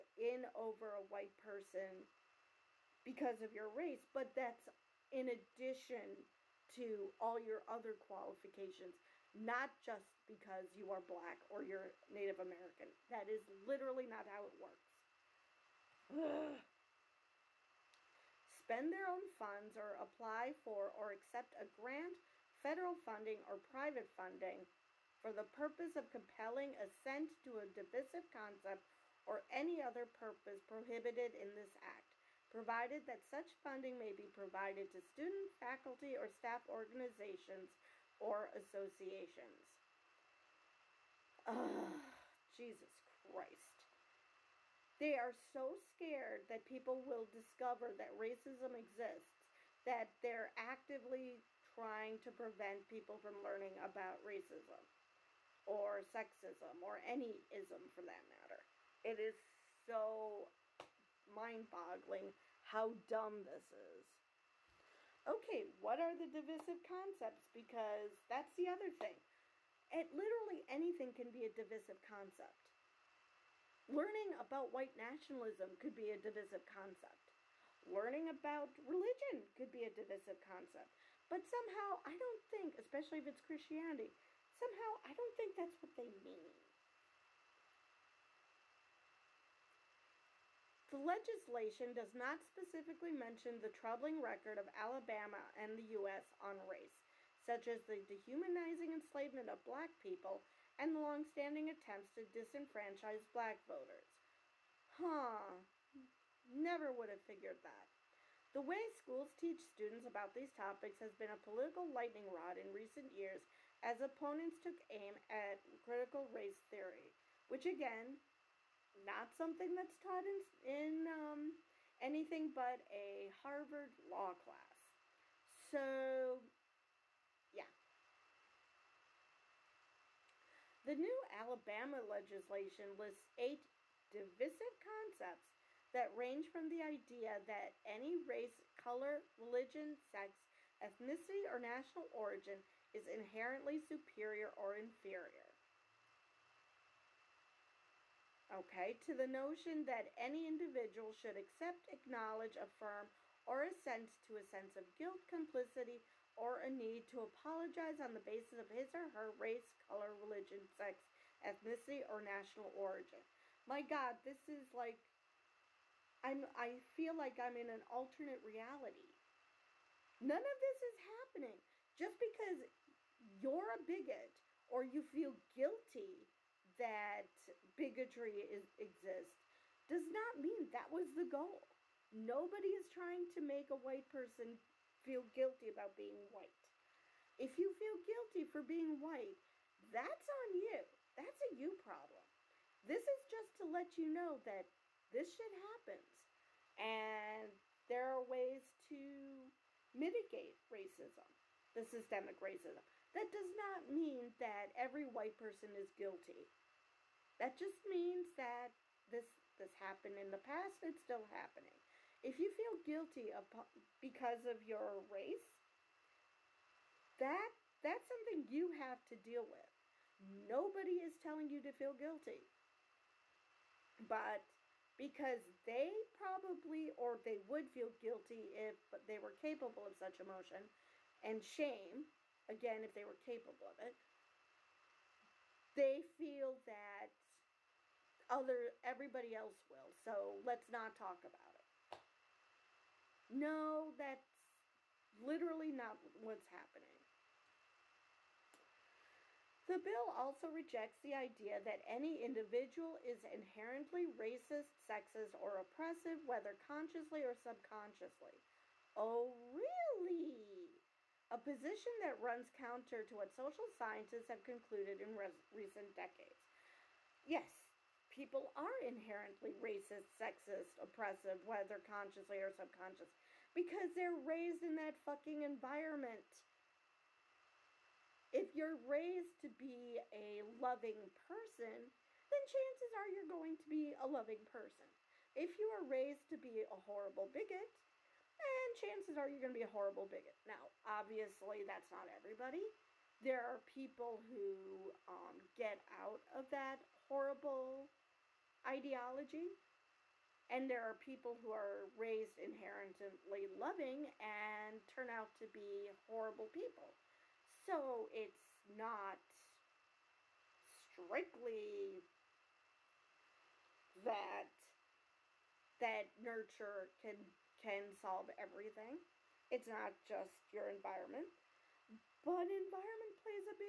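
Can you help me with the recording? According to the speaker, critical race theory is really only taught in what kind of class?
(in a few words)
A Harvard law class.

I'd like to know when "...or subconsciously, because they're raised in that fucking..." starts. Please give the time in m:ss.
4:32.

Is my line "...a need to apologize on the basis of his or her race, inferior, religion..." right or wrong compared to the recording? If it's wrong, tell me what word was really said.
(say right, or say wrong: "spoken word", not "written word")
wrong: "color", not "inferior".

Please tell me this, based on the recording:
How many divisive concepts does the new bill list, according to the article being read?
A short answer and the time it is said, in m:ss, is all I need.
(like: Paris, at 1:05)
8, at 2:13.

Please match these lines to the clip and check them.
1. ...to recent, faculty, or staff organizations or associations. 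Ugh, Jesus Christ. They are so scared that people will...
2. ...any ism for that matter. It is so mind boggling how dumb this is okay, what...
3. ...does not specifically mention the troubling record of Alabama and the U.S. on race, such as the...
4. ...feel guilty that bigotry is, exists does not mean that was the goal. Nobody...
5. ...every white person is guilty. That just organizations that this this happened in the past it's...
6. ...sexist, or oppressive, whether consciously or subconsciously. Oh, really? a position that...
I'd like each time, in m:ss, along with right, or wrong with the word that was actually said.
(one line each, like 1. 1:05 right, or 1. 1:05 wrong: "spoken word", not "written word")
1. 0:34 wrong: "student", not "recent"
2. 0:56 right
3. 1:31 right
4. 2:55 right
5. 3:24 wrong: "means", not "organizations"
6. 4:14 right.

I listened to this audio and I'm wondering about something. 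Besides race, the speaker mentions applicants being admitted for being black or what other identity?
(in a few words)
Native American.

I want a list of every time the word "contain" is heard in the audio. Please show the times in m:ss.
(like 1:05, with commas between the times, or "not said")
not said.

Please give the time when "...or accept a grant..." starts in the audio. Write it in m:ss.
0:20.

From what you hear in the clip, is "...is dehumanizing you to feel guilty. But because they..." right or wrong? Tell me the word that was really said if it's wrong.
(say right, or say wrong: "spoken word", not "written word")
wrong: "telling", not "dehumanizing".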